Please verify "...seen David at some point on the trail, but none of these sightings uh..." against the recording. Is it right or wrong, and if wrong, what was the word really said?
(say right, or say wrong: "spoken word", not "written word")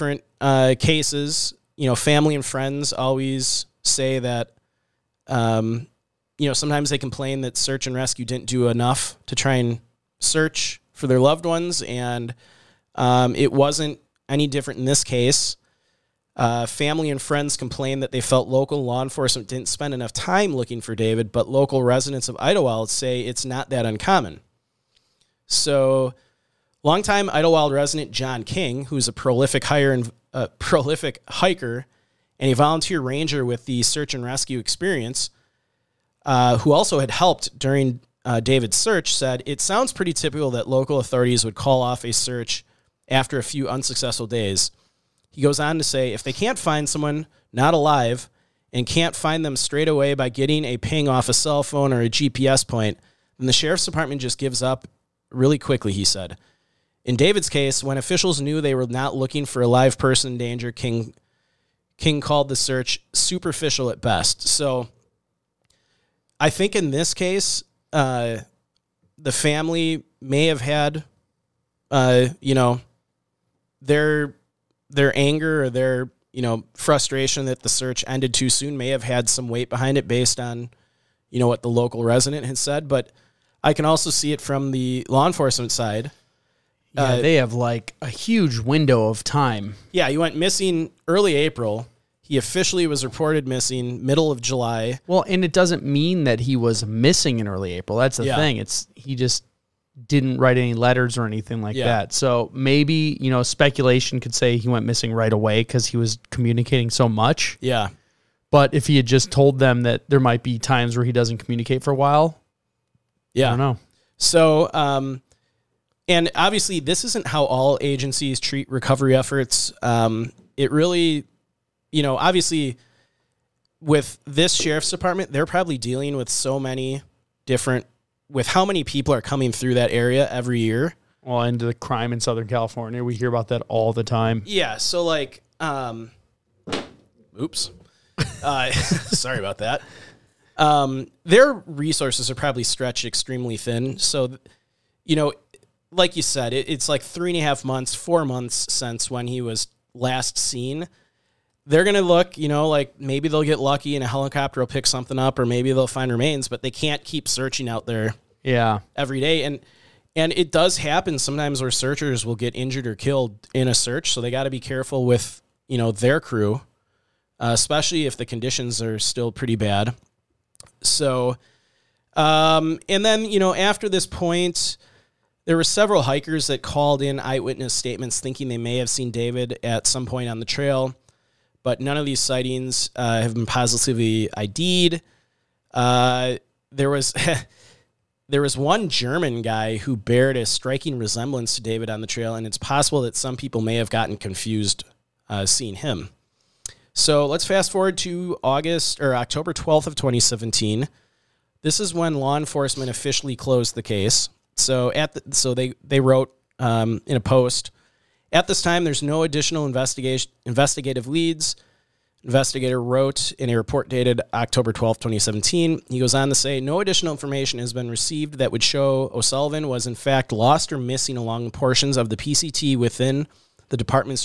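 right.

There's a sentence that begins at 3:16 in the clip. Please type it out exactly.
So let's fast forward to August or October 12th of 2017.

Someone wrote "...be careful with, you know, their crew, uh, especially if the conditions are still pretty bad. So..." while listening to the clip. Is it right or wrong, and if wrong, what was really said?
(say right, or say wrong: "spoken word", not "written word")
right.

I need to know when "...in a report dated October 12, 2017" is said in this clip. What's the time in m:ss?
3:33.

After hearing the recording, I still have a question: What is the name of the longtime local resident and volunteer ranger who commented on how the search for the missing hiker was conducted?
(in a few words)
John King.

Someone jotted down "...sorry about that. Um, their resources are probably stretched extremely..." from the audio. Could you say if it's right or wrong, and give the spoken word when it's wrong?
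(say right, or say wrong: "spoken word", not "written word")
right.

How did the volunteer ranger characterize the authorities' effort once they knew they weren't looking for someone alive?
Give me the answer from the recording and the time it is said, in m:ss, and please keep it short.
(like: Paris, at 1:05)
Superficial, at 1:03.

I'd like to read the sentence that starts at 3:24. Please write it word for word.
So at the, so they they wrote um, in a post.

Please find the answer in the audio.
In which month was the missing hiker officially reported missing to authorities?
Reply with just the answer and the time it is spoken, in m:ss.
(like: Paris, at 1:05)
July, at 1:34.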